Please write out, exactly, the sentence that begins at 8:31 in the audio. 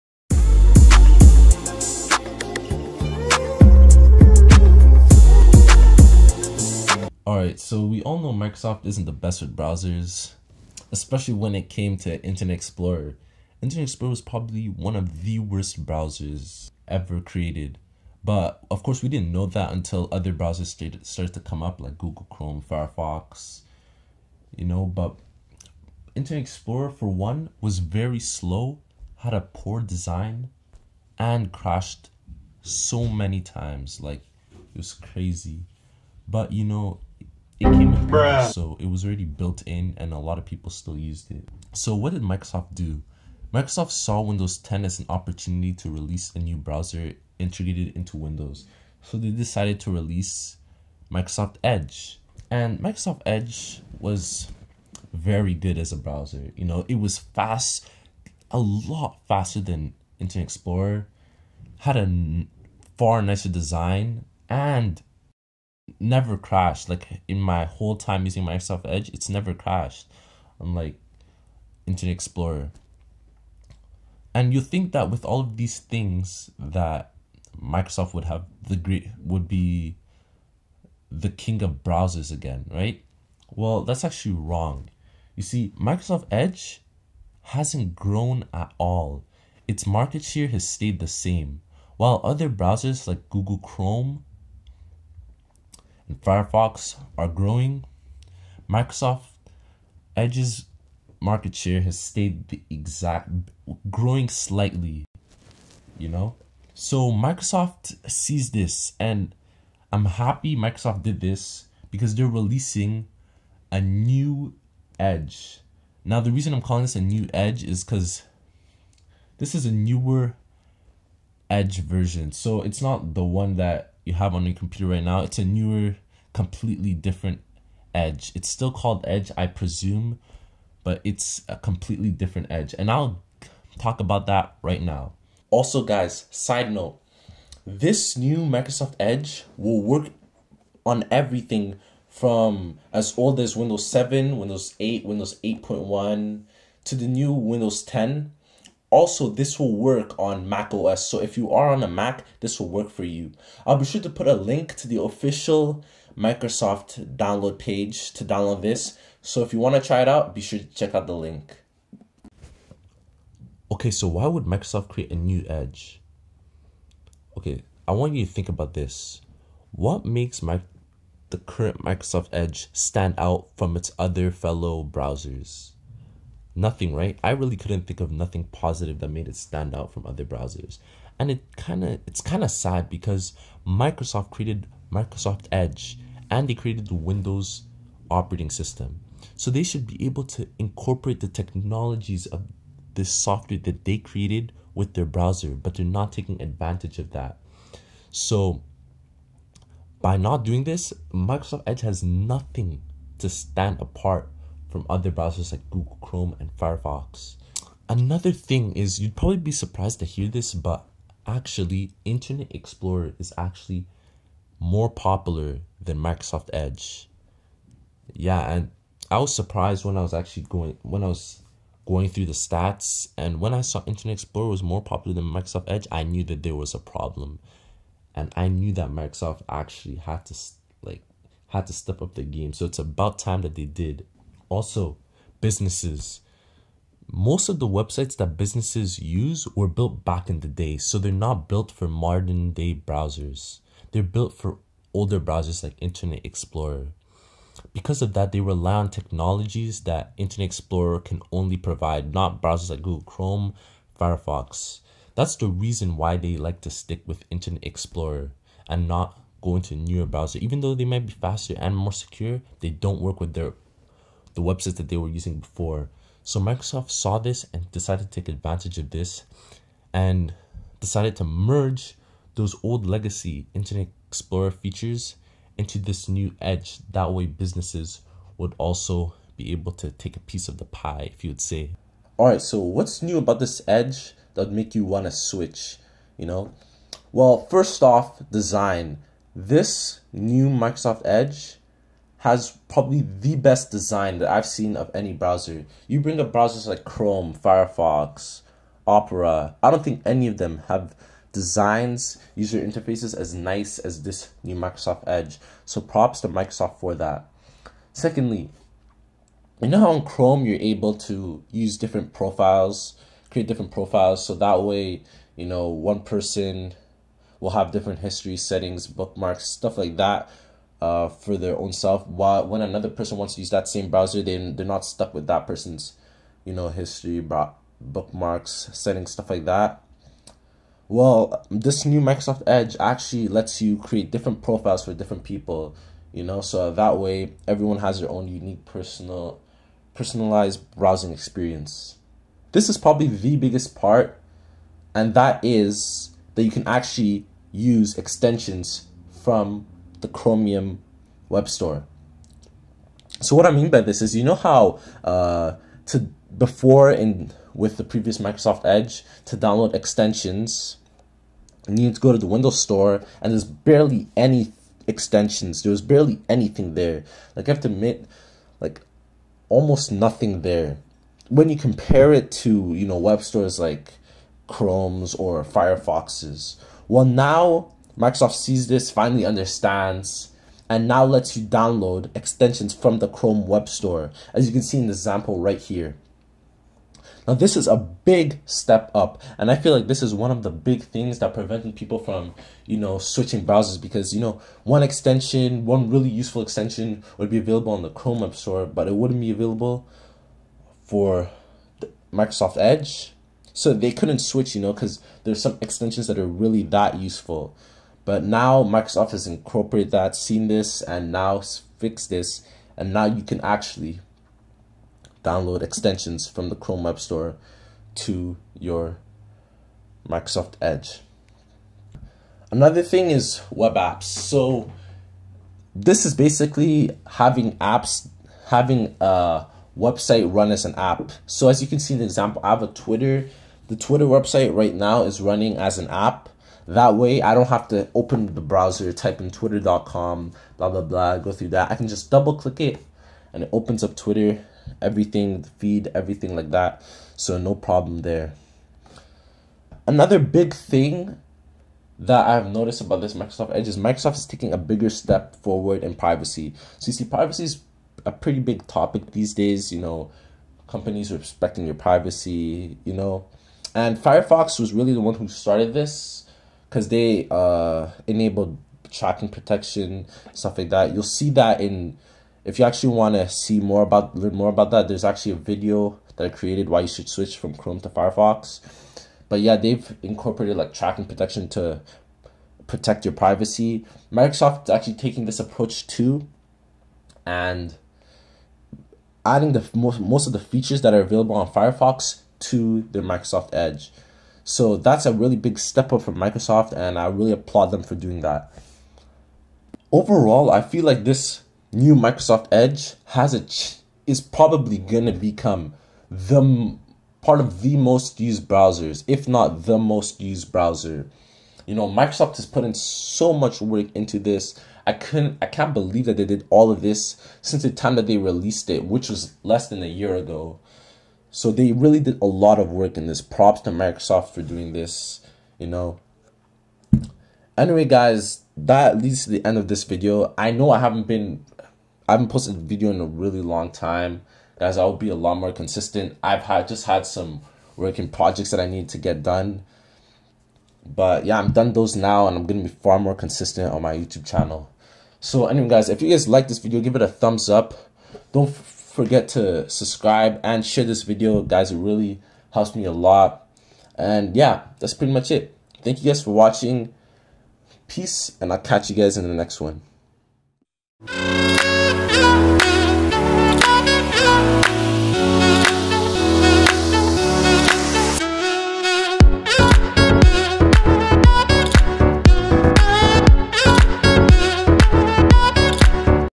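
You know, Microsoft has put in so much work into this.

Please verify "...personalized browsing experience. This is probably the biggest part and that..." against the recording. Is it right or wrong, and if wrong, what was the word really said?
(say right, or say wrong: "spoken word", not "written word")
right.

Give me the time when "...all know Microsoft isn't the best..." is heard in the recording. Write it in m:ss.
0:08.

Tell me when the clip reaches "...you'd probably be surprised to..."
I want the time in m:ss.
3:28.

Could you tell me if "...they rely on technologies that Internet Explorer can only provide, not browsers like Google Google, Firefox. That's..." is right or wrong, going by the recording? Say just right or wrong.
wrong.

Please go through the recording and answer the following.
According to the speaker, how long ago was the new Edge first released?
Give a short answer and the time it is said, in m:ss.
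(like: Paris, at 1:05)
less than a year, at 8:39.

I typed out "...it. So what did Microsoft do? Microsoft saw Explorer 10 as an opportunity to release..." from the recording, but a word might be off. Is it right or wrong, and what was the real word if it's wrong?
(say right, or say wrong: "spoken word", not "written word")
wrong: "Windows", not "Explorer".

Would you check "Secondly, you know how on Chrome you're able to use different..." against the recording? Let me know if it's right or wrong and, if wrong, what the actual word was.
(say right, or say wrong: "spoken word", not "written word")
right.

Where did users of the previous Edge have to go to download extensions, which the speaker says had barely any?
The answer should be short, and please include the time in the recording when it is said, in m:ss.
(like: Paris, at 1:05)
Windows Store, at 6:02.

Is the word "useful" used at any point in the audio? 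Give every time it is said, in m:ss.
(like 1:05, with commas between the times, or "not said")
6:36, 6:46.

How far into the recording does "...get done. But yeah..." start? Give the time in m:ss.
8:58.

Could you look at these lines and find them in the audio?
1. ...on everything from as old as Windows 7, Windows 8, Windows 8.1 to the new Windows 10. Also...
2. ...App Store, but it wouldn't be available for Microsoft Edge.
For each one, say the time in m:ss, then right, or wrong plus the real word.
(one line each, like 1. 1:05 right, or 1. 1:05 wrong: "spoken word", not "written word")
1. 2:20 right
2. 6:38 right.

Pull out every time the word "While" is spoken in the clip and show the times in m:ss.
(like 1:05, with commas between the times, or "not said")
1:31, 5:22.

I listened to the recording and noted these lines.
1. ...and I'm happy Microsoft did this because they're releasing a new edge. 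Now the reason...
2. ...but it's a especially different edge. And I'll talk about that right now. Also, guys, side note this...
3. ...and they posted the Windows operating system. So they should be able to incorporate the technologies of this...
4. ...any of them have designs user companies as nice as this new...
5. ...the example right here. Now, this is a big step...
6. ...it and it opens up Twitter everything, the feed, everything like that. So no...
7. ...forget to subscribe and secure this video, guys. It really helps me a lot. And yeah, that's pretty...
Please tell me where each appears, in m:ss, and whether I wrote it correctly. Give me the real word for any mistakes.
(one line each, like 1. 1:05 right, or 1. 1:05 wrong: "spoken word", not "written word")
1. 1:48 right
2. 2:10 wrong: "completely", not "especially"
3. 3:06 wrong: "created", not "posted"
4. 5:00 wrong: "interfaces", not "companies"
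5. 6:24 right
6. 7:22 right
7. 9:08 wrong: "share", not "secure".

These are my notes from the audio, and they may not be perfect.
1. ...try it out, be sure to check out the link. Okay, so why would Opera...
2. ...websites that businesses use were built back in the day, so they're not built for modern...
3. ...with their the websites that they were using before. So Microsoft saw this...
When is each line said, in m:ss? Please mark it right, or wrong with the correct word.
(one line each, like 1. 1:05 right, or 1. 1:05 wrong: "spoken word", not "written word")
1. 2:39 wrong: "Microsoft", not "Opera"
2. 3:57 right
3. 4:23 right.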